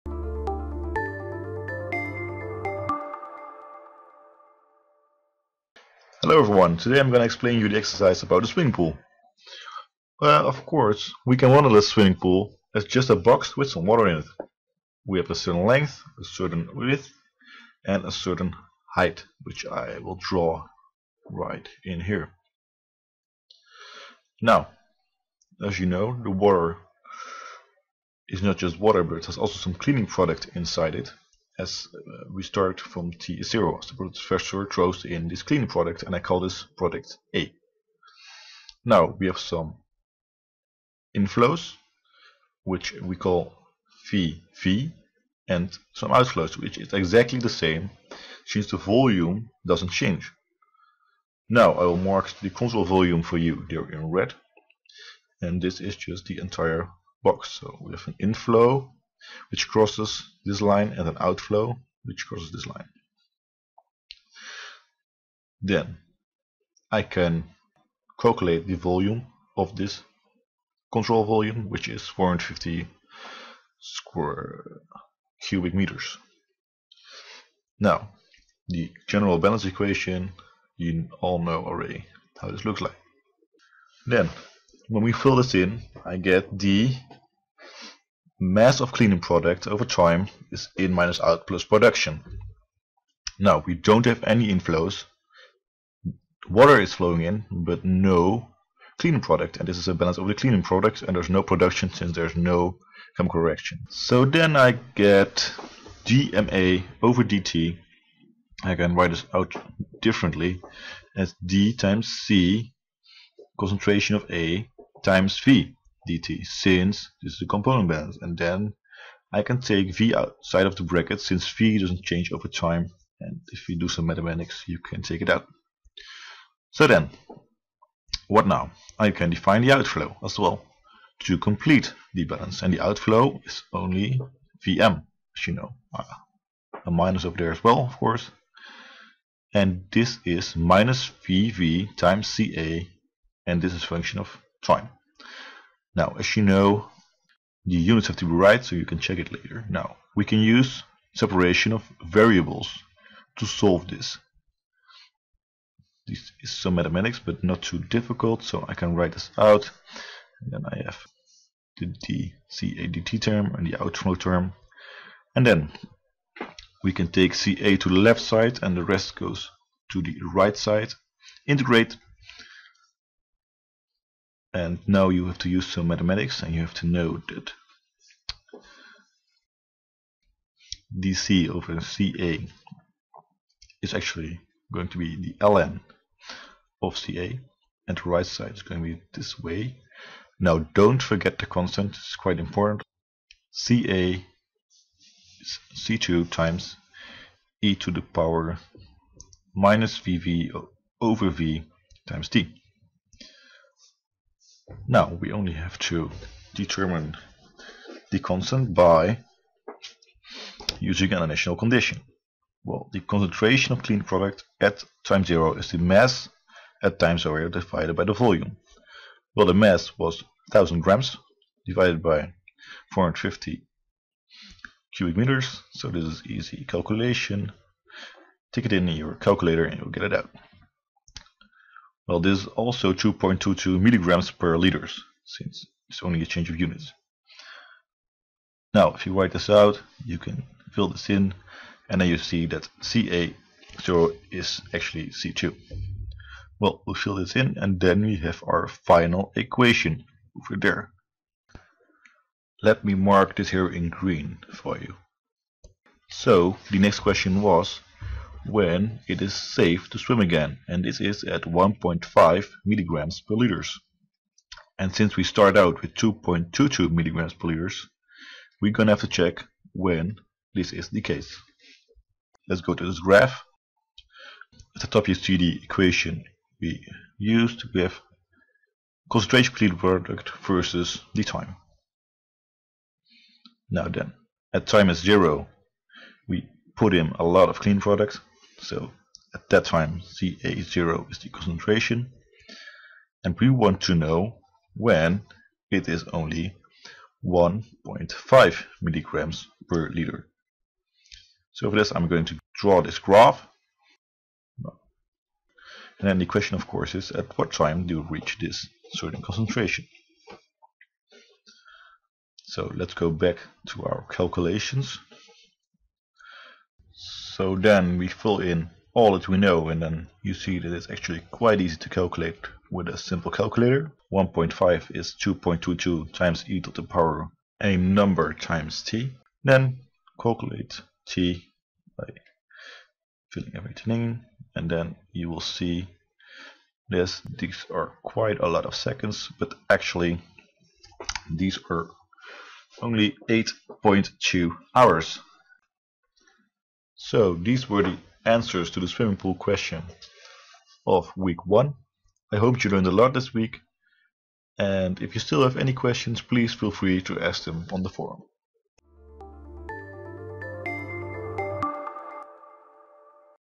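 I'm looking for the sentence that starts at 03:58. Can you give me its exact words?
Now, if you write this out, you can fill this in, and then you see that CA0 is actually C2.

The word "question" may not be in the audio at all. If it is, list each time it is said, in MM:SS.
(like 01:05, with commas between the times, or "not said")
04:16, 05:06, 05:49, 05:55.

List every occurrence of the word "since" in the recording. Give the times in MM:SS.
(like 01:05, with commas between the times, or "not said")
00:48, 01:41, 01:56, 02:01, 03:55, 04:24.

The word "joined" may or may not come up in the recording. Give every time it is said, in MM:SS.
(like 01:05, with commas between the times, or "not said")
not said.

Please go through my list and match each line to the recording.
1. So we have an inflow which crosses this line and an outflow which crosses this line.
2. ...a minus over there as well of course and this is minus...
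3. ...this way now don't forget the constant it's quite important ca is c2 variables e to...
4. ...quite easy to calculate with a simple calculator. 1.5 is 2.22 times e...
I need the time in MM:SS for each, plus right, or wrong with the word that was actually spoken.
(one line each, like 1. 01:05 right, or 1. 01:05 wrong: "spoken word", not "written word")
1. 00:57 right
2. 02:16 right
3. 03:09 wrong: "times", not "variables"
4. 05:21 right.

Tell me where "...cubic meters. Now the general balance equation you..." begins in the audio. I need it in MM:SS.
01:15.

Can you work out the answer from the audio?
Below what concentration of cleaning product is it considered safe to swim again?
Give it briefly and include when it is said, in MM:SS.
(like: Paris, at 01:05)
1.5 mg/L, at 04:21.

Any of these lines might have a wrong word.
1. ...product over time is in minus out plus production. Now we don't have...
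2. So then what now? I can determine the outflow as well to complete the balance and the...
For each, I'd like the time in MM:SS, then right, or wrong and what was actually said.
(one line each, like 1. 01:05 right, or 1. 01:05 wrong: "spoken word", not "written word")
1. 01:29 right
2. 02:06 wrong: "define", not "determine".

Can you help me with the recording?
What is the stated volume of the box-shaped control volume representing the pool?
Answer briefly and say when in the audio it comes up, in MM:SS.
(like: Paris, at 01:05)
450 cubic meters, at 01:12.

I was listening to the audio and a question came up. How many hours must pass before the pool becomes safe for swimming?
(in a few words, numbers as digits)
8.2 hours.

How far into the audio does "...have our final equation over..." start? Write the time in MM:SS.
04:08.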